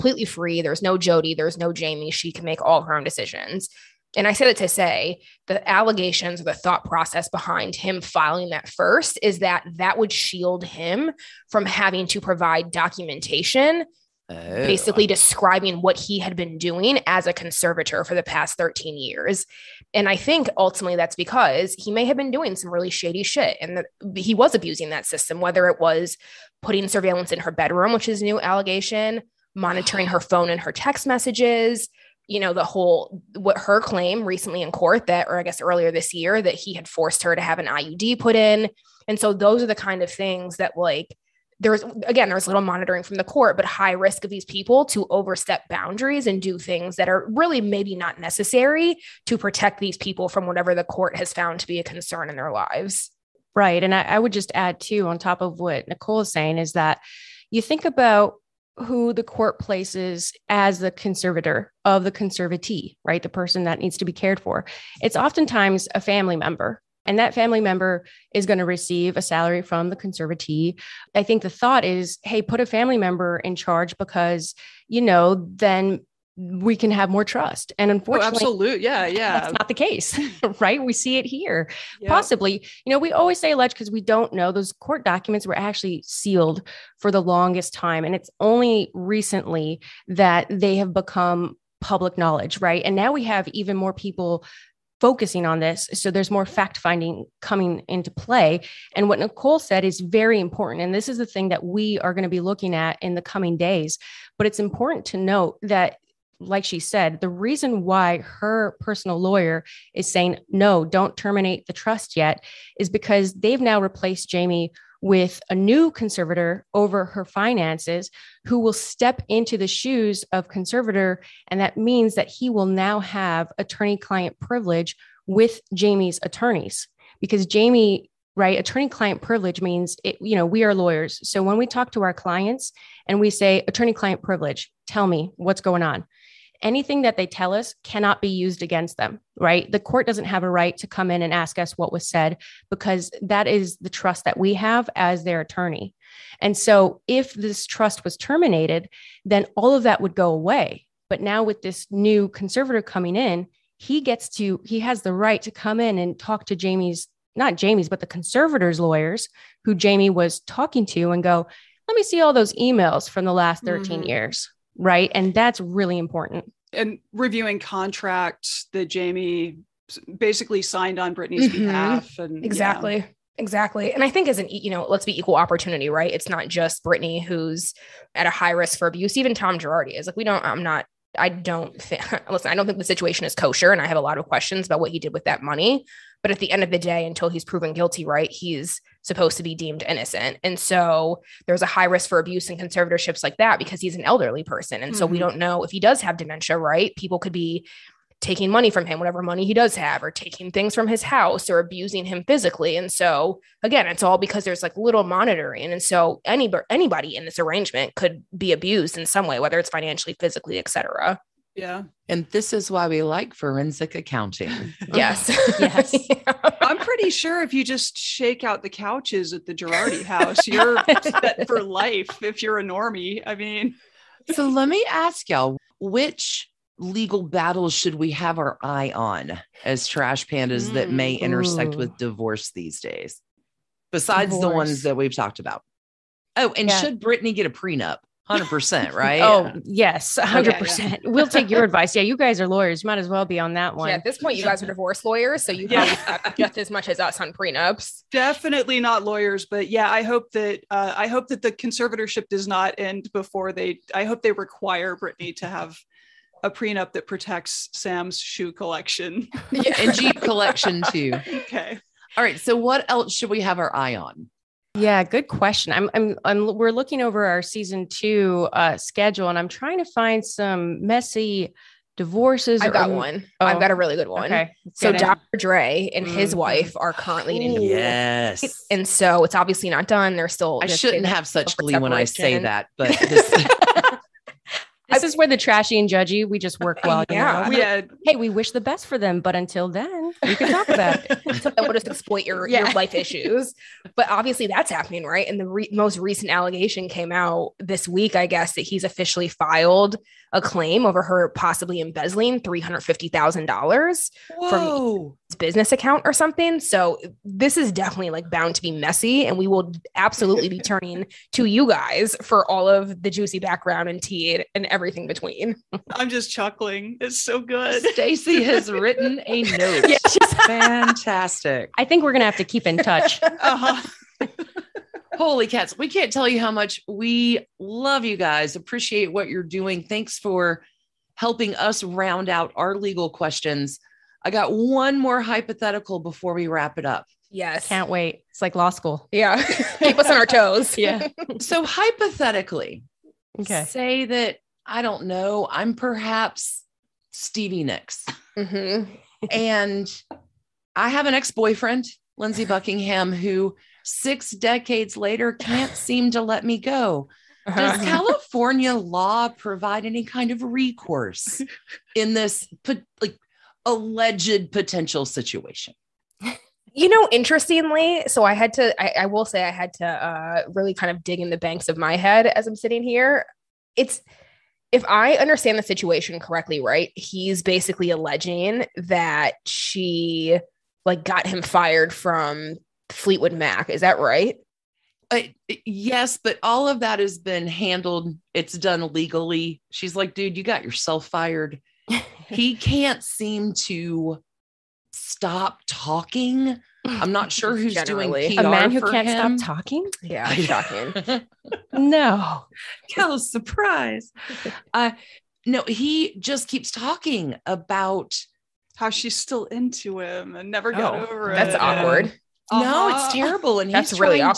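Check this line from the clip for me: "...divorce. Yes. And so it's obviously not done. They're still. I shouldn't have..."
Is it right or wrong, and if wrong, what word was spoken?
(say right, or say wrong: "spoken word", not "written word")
right.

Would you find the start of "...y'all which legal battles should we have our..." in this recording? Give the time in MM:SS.
03:45.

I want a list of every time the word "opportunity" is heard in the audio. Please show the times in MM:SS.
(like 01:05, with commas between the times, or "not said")
02:55.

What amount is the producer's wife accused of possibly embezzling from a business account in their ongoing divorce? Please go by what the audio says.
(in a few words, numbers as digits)
$350,000.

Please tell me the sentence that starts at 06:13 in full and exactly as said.
It's, if I understand the situation correctly, right, he's basically alleging that she like got him fired from Fleetwood Mac.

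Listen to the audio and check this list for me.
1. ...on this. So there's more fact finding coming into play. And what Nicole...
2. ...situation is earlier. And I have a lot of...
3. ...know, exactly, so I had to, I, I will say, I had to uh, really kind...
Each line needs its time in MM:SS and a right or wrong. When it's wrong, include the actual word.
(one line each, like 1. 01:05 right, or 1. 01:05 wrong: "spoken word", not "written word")
1. 01:35 right
2. 03:02 wrong: "kosher", not "earlier"
3. 06:06 wrong: "interestingly", not "exactly".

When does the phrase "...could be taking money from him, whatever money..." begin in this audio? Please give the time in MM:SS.
03:17.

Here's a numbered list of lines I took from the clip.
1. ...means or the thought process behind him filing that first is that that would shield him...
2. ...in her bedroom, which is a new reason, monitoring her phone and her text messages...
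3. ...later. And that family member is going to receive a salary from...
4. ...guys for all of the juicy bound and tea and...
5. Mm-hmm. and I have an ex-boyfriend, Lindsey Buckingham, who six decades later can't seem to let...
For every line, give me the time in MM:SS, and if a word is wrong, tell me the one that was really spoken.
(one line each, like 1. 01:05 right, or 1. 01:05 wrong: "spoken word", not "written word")
1. 00:05 wrong: "allegations", not "means"
2. 00:27 wrong: "allegation", not "reason"
3. 01:06 wrong: "member", not "later"
4. 05:11 wrong: "background", not "bound"
5. 05:48 right.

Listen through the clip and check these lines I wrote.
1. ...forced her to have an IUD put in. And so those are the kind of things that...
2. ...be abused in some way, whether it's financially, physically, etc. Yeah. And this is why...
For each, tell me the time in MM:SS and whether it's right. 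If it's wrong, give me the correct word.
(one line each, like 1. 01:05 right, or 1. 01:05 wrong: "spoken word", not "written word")
1. 00:36 right
2. 03:28 right.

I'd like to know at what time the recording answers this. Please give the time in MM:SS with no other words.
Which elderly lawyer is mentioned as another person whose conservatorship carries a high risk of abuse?
02:59.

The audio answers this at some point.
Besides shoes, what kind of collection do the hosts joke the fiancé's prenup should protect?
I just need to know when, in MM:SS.
04:19.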